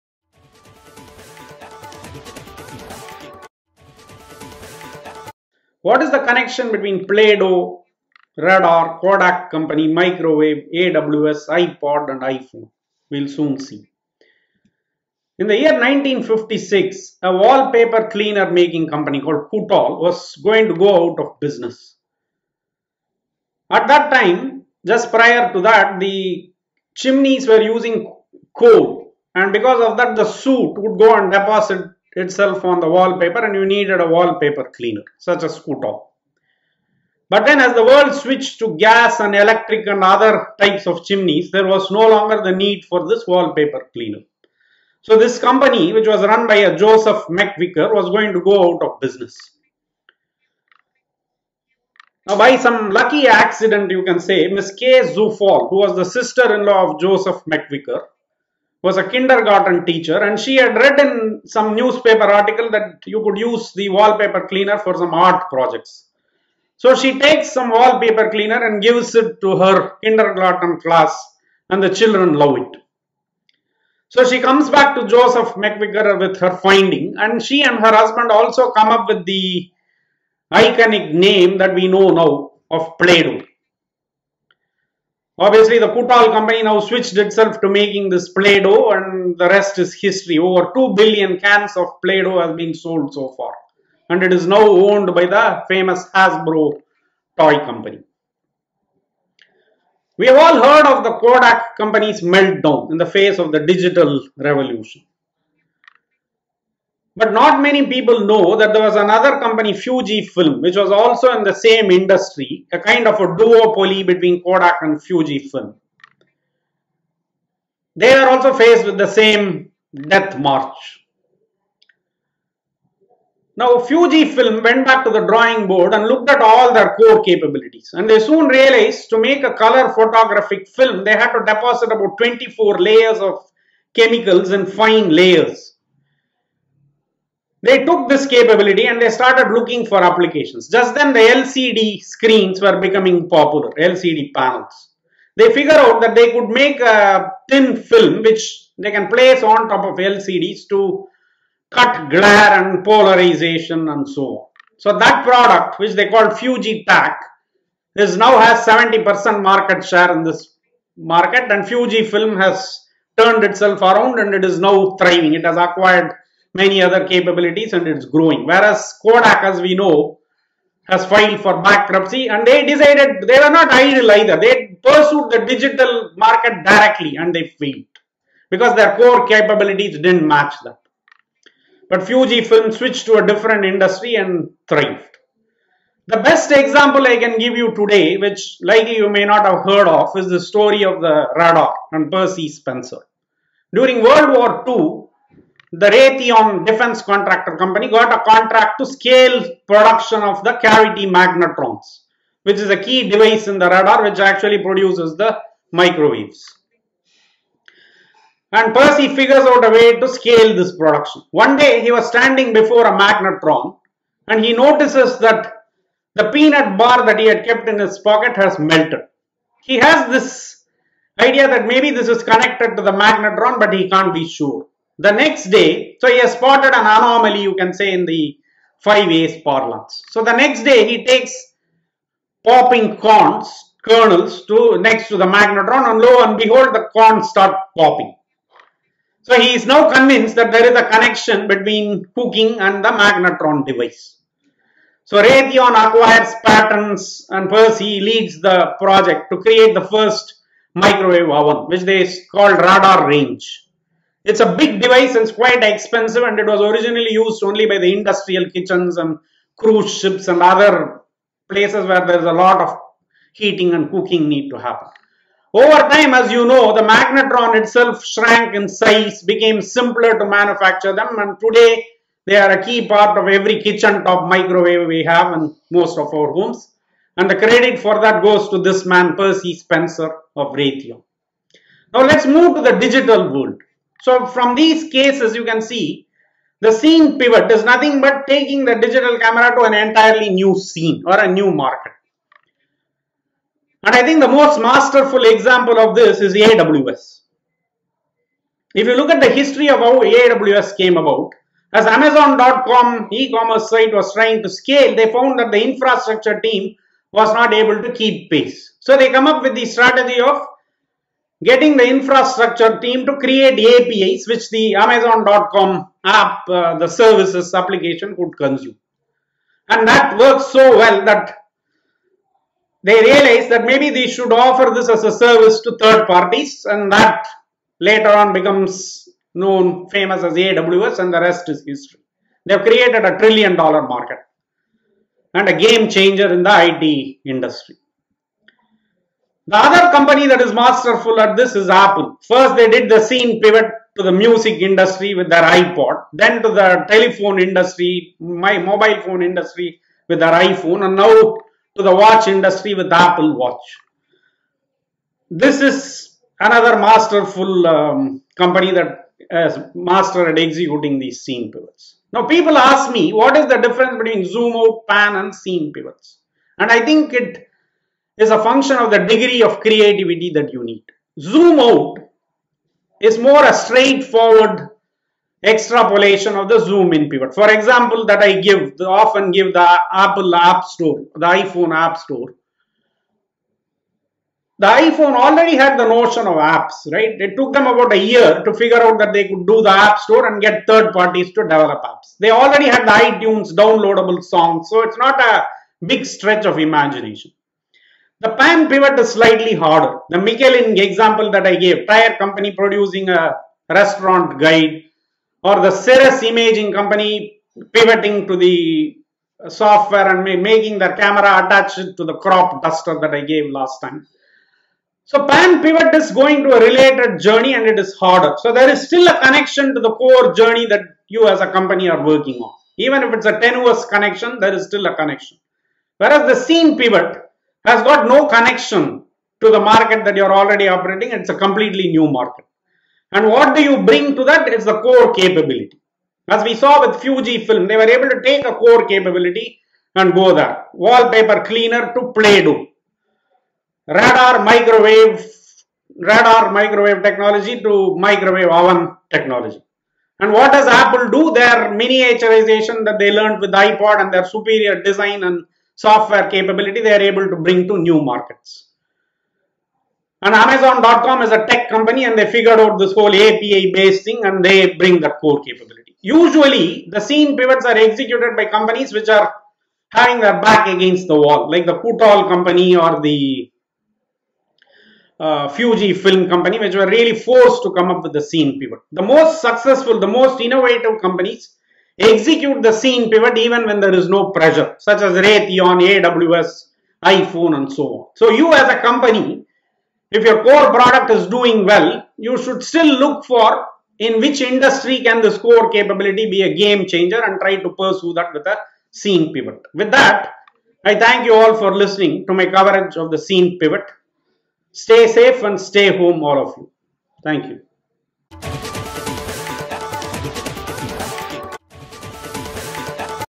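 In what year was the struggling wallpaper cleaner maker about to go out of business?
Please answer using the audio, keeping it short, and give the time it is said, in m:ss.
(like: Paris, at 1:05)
1956, at 0:15.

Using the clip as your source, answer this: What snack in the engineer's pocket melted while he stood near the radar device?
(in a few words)
peanut bar.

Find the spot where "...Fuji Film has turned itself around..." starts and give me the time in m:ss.
2:41.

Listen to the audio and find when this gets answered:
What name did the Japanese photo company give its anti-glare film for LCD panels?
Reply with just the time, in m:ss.
2:36.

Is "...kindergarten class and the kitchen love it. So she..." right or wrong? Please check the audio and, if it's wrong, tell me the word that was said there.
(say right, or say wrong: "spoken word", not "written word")
wrong: "children", not "kitchen".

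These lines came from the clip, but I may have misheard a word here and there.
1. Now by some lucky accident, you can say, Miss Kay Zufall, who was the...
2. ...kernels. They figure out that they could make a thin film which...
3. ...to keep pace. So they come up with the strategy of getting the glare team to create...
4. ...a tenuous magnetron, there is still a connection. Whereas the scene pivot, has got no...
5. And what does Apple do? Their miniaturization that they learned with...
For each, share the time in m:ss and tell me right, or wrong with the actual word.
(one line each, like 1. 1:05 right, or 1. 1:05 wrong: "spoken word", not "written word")
1. 0:52 right
2. 2:24 wrong: "panels", not "kernels"
3. 5:07 wrong: "infrastructure", not "glare"
4. 7:03 wrong: "connection", not "magnetron"
5. 7:30 right.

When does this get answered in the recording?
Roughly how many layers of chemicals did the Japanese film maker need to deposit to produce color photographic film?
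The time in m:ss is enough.
2:12.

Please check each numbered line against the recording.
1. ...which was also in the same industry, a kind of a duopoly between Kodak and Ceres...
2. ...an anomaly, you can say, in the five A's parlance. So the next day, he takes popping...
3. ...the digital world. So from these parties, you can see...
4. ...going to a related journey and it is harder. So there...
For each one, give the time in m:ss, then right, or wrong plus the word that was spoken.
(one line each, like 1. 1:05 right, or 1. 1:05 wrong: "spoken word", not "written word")
1. 1:50 wrong: "Fuji", not "Ceres"
2. 3:46 right
3. 4:42 wrong: "cases", not "parties"
4. 6:56 right.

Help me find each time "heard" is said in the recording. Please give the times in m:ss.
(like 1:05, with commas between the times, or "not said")
1:40, 3:09.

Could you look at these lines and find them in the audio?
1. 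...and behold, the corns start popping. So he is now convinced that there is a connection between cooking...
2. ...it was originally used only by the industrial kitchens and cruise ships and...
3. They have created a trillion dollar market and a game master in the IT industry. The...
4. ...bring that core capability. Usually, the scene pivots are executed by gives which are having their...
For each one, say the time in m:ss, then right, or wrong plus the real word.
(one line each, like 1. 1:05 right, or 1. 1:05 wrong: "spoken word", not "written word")
1. 3:56 right
2. 4:16 right
3. 5:32 wrong: "changer", not "master"
4. 7:44 wrong: "companies", not "gives".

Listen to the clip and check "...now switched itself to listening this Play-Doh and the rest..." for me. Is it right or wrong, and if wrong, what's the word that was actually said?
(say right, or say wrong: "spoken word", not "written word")
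wrong: "making", not "listening".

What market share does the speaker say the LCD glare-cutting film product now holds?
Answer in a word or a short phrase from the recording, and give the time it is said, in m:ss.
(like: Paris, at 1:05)
70%, at 2:38.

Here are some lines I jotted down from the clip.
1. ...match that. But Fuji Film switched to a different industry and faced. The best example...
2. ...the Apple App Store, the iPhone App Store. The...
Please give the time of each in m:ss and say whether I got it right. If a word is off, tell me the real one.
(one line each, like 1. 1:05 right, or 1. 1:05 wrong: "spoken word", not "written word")
1. 3:00 wrong: "thrived", not "faced"
2. 6:19 right.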